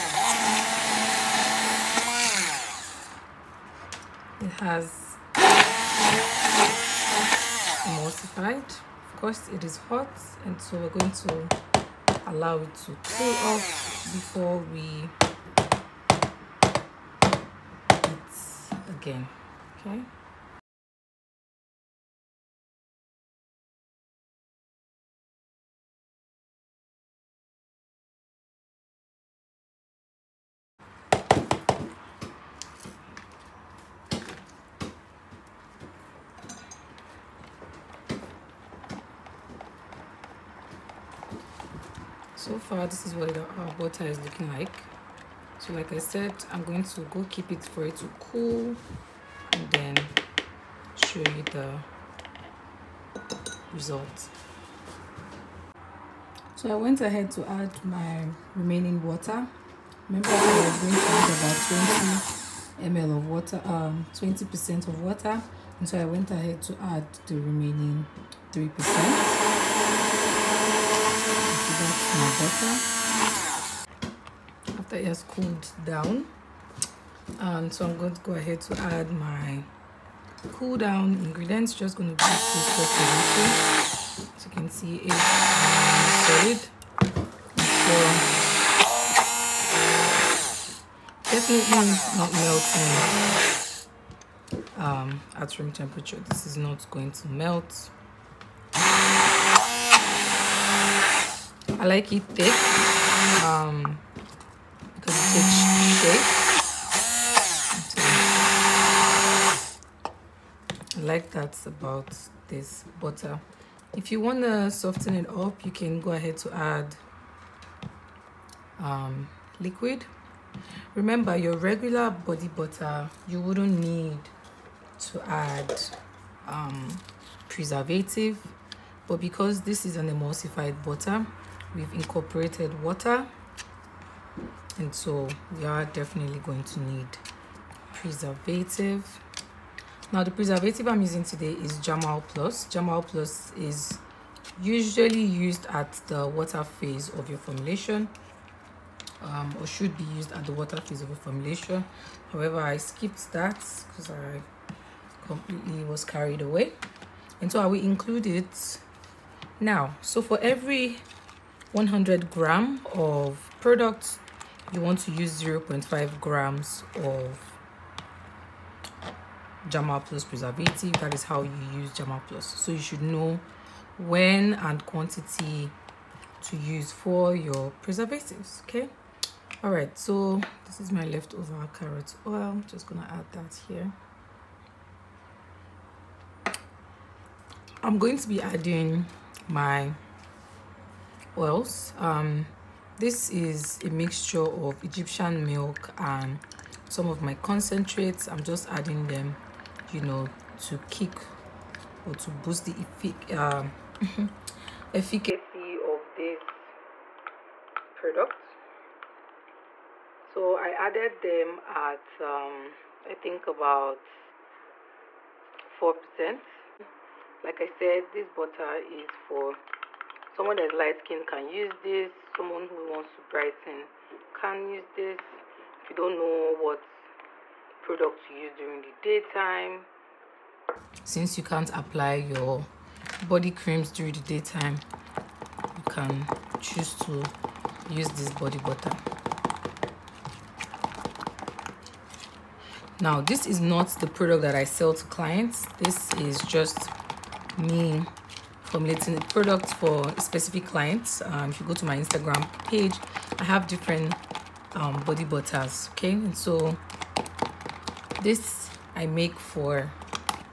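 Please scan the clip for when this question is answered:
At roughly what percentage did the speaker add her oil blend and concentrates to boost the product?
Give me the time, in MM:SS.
03:35.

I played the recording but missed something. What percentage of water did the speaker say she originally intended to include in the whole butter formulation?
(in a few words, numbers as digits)
20%.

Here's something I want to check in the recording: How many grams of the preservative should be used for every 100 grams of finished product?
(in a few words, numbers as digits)
0.5 grams.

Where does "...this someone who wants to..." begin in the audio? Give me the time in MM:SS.
03:41.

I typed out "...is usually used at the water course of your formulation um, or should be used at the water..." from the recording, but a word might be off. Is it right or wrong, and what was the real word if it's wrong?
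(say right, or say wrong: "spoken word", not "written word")
wrong: "phase", not "course".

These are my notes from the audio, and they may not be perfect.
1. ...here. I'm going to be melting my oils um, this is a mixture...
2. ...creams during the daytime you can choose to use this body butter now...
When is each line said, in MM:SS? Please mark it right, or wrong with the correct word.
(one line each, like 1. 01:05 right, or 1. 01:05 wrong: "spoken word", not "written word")
1. 03:03 wrong: "adding", not "melting"
2. 03:53 right.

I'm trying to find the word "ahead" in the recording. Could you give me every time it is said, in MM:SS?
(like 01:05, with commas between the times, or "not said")
00:57, 01:06, 01:18, 01:56.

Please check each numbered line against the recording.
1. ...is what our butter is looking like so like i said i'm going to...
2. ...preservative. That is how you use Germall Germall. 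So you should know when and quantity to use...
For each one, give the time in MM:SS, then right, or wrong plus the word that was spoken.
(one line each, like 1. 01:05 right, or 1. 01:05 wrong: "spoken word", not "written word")
1. 00:43 right
2. 02:50 wrong: "Plus", not "Germall".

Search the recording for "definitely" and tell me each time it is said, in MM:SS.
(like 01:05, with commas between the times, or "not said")
01:31, 02:15.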